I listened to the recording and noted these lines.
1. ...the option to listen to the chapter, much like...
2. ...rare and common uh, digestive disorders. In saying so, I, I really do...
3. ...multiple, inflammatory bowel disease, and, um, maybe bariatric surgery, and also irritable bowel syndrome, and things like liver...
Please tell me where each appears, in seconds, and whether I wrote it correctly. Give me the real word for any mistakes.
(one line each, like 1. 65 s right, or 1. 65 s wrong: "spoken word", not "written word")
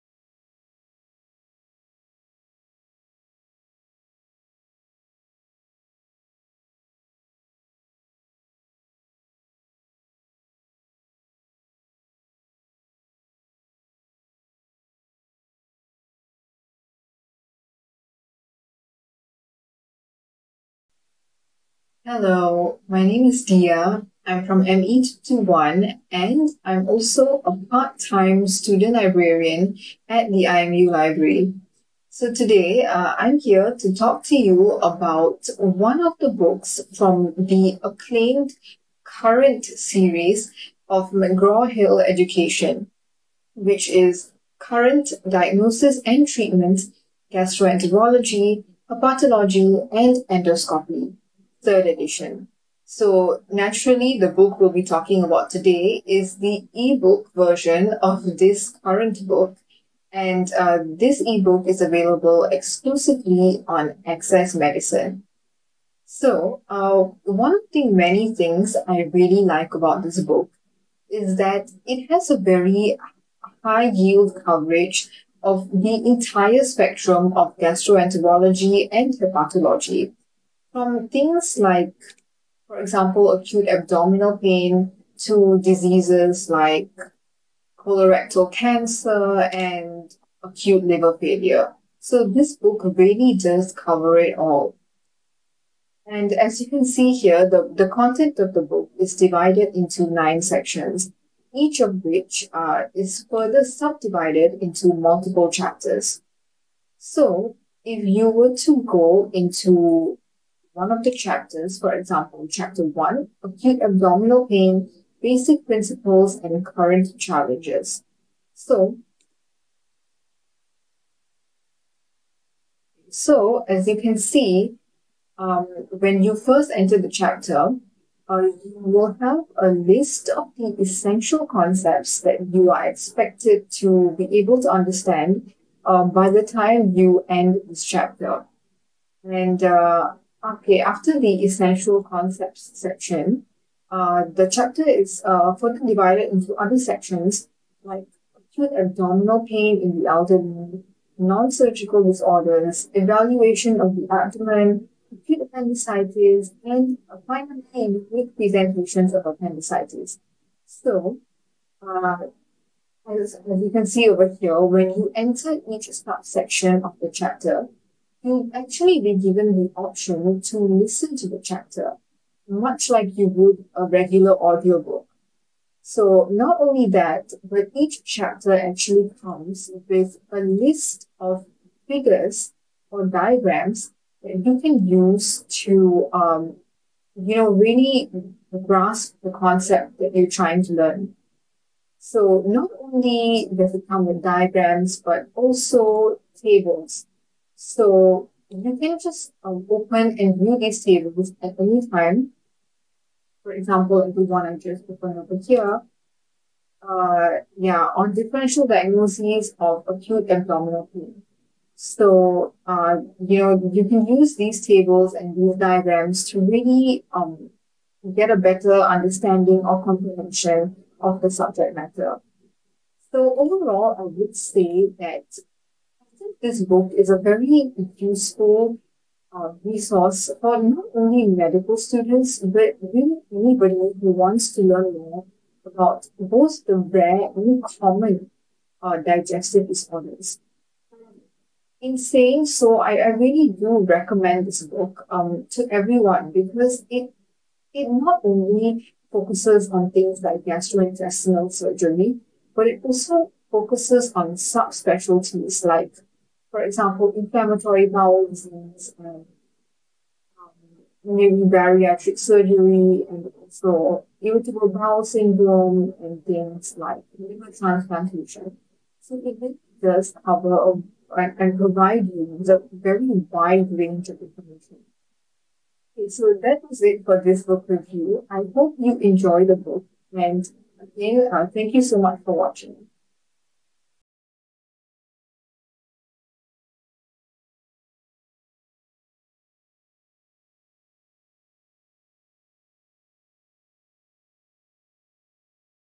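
1. 169 s right
2. 236 s right
3. 256 s wrong: "example", not "multiple".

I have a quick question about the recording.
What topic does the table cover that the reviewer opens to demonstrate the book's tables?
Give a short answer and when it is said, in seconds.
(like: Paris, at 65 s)
Differential diagnoses of acute abdominal pain, at 208 s.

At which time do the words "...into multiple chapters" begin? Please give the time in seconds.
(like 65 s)
104 s.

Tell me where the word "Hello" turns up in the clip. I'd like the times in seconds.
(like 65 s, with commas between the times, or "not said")
22 s.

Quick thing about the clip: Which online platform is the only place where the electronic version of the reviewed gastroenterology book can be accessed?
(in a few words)
Access Medicine.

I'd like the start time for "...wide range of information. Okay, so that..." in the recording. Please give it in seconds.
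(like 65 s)
273 s.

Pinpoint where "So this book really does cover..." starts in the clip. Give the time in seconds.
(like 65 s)
91 s.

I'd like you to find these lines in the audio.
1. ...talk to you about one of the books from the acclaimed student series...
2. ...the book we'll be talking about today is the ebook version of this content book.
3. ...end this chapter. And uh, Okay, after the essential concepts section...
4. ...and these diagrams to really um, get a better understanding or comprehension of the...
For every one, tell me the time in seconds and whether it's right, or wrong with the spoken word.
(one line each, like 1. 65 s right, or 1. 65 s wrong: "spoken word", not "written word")
1. 33 s wrong: "current", not "student"
2. 54 s wrong: "current", not "content"
3. 137 s right
4. 215 s right.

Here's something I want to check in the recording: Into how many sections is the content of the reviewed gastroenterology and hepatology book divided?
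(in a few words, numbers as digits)
9.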